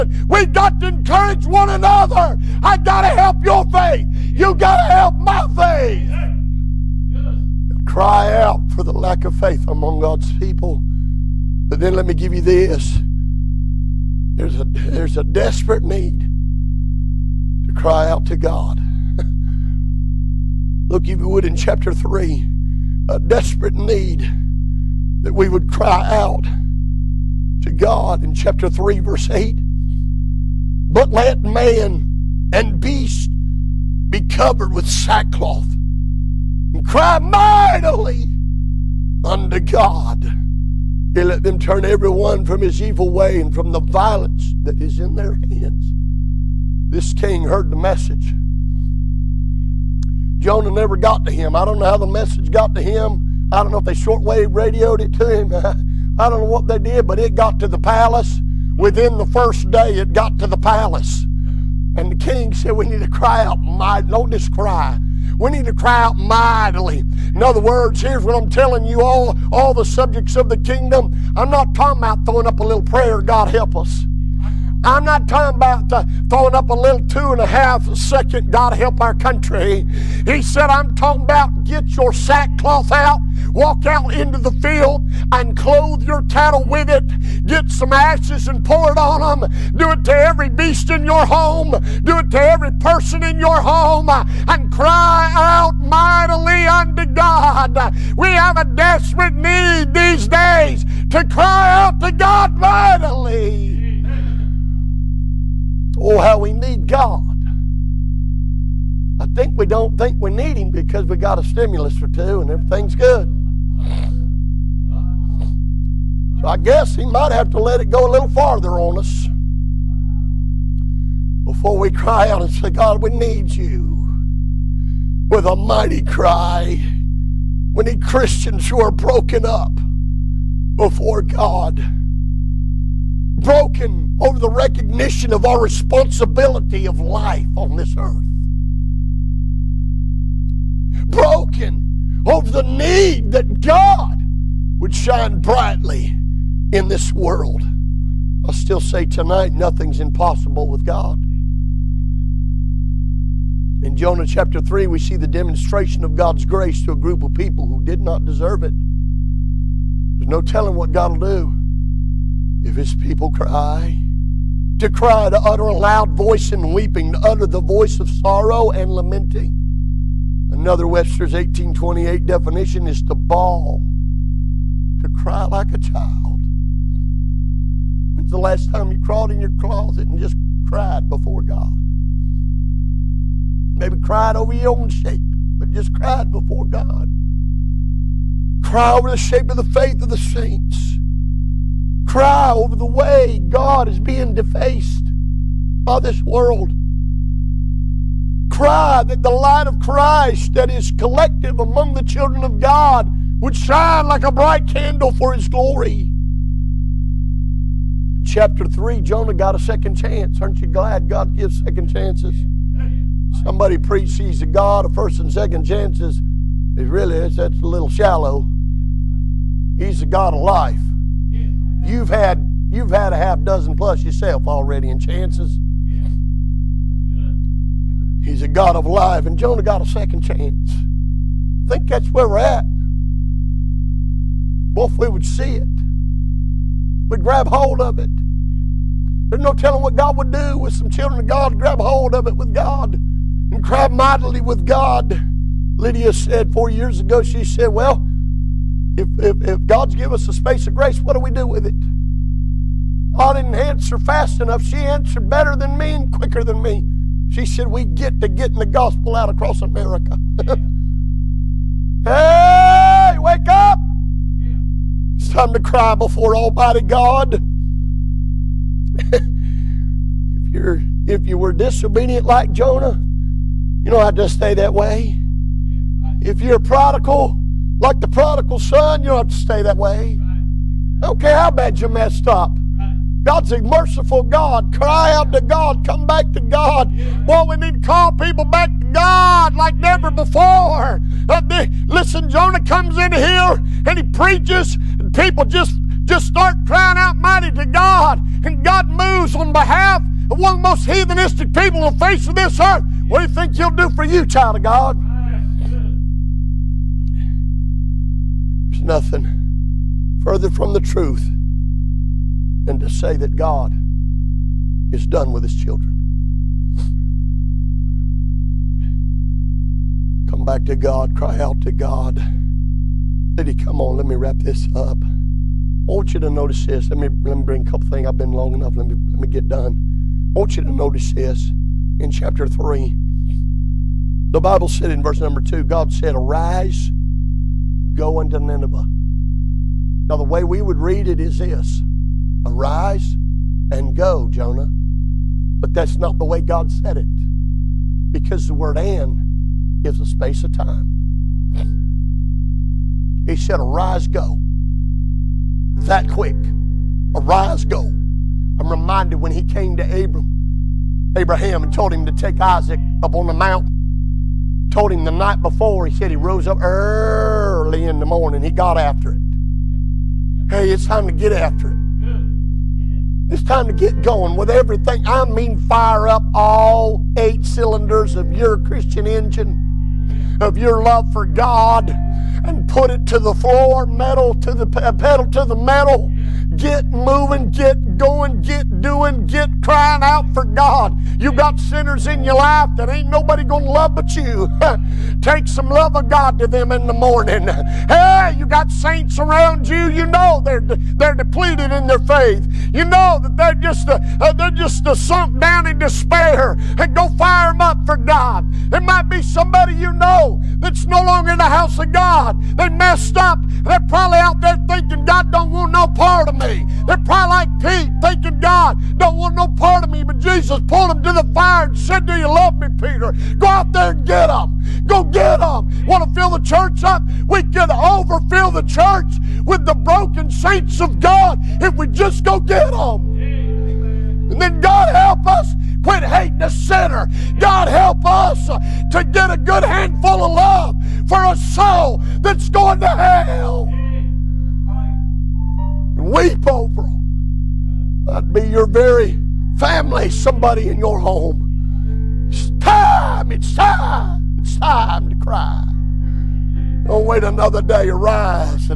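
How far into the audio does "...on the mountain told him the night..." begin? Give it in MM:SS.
06:03.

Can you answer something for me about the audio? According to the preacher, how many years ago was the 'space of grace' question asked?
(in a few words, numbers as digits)
4.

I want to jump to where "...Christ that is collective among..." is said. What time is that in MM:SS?
03:19.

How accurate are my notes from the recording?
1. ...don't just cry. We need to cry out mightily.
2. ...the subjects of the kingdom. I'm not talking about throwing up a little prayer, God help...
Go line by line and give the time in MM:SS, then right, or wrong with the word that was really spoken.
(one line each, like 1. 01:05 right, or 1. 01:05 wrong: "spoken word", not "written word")
1. 01:04 right
2. 01:09 right.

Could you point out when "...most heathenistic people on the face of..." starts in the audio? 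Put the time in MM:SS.
05:00.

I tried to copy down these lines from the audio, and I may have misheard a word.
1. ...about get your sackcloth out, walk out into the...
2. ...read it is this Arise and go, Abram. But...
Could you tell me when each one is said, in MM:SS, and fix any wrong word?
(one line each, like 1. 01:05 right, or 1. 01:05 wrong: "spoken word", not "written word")
1. 01:21 right
2. 05:40 wrong: "Jonah", not "Abram".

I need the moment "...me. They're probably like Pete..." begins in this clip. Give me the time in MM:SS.
06:56.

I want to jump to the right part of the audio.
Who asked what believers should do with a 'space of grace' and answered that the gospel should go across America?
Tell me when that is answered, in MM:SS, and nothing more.
04:05.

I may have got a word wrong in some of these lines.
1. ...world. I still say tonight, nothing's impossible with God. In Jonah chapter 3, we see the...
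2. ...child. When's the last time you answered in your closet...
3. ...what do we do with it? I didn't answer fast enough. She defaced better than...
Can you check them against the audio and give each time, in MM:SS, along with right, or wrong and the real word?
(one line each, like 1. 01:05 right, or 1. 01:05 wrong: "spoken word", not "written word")
1. 02:27 right
2. 02:55 wrong: "crawled", not "answered"
3. 04:10 wrong: "answered", not "defaced".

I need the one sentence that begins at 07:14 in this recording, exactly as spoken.
And then God help us quit hating a sinner.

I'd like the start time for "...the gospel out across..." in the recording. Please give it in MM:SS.
04:18.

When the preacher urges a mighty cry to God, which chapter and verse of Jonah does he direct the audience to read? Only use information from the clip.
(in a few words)
Chapter 3, verse 8.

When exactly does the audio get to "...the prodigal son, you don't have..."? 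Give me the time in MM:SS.
04:38.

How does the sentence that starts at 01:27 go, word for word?
Get some ashes and pour it on them.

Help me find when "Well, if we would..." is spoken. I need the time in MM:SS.
03:54.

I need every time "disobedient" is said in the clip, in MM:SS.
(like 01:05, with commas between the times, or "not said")
04:31.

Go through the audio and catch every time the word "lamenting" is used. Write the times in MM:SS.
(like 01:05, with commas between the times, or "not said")
02:48.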